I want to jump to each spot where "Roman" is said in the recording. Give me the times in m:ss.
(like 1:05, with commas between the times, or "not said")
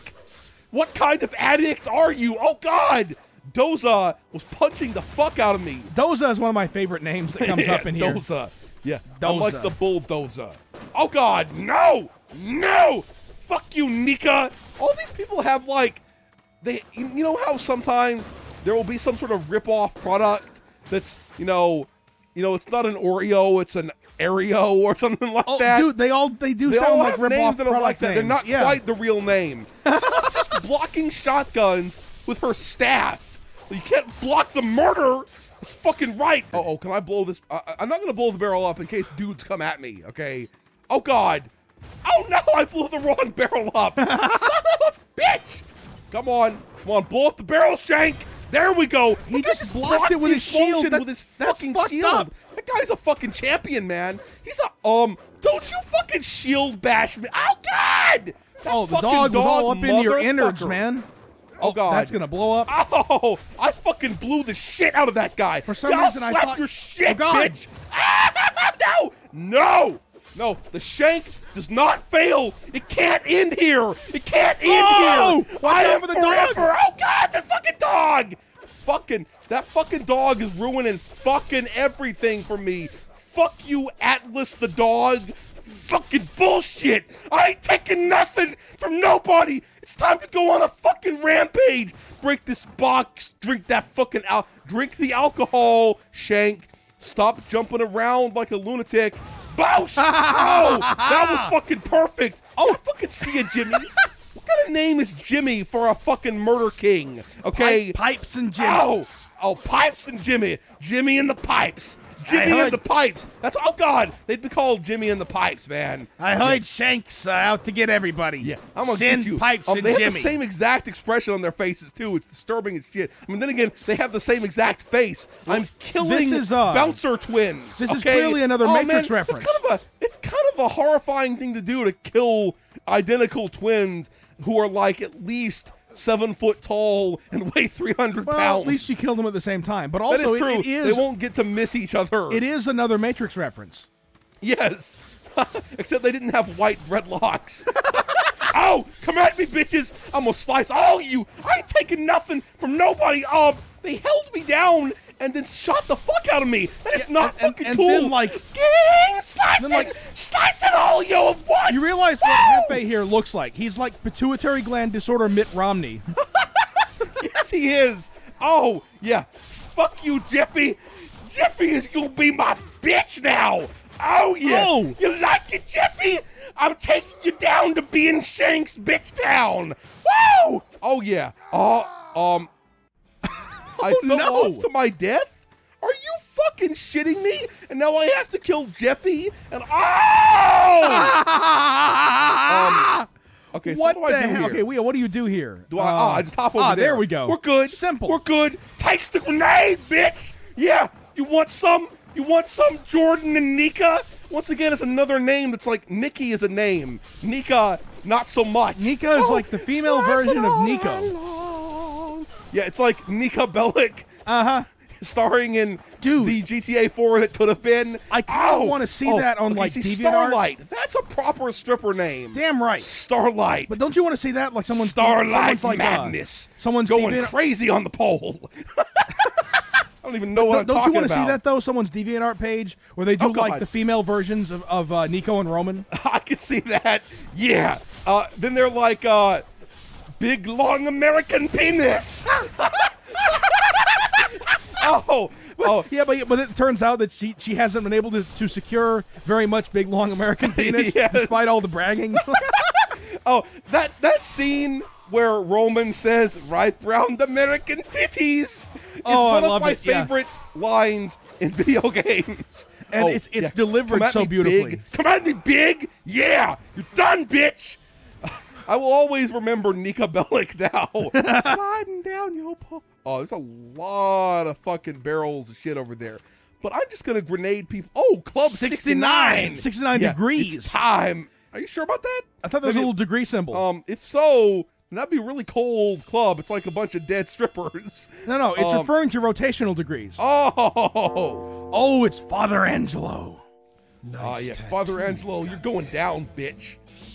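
3:55, 4:15.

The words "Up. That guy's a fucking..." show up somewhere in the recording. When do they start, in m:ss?
0:52.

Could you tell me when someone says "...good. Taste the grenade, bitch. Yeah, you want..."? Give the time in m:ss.
3:18.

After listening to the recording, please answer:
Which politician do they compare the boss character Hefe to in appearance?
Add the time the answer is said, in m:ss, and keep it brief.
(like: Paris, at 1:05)
Mitt Romney, at 2:45.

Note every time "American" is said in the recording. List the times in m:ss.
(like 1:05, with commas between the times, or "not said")
4:00, 4:10, 4:17.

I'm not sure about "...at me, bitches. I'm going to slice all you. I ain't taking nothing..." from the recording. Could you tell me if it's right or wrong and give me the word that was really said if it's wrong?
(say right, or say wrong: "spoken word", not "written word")
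right.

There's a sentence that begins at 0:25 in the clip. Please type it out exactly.
Dude, they all they do they sound like rip that are like that.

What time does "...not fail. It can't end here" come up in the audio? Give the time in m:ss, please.
1:11.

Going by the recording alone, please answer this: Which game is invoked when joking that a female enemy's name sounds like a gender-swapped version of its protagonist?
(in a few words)
GTA 4.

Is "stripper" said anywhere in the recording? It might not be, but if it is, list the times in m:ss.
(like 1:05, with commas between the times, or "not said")
3:41, 4:47.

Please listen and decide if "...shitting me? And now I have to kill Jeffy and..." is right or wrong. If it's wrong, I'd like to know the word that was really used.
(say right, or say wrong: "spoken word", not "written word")
right.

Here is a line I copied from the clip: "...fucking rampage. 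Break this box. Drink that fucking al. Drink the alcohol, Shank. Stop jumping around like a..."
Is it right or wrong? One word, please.
right.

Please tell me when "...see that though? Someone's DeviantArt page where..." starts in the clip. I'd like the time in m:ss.
3:51.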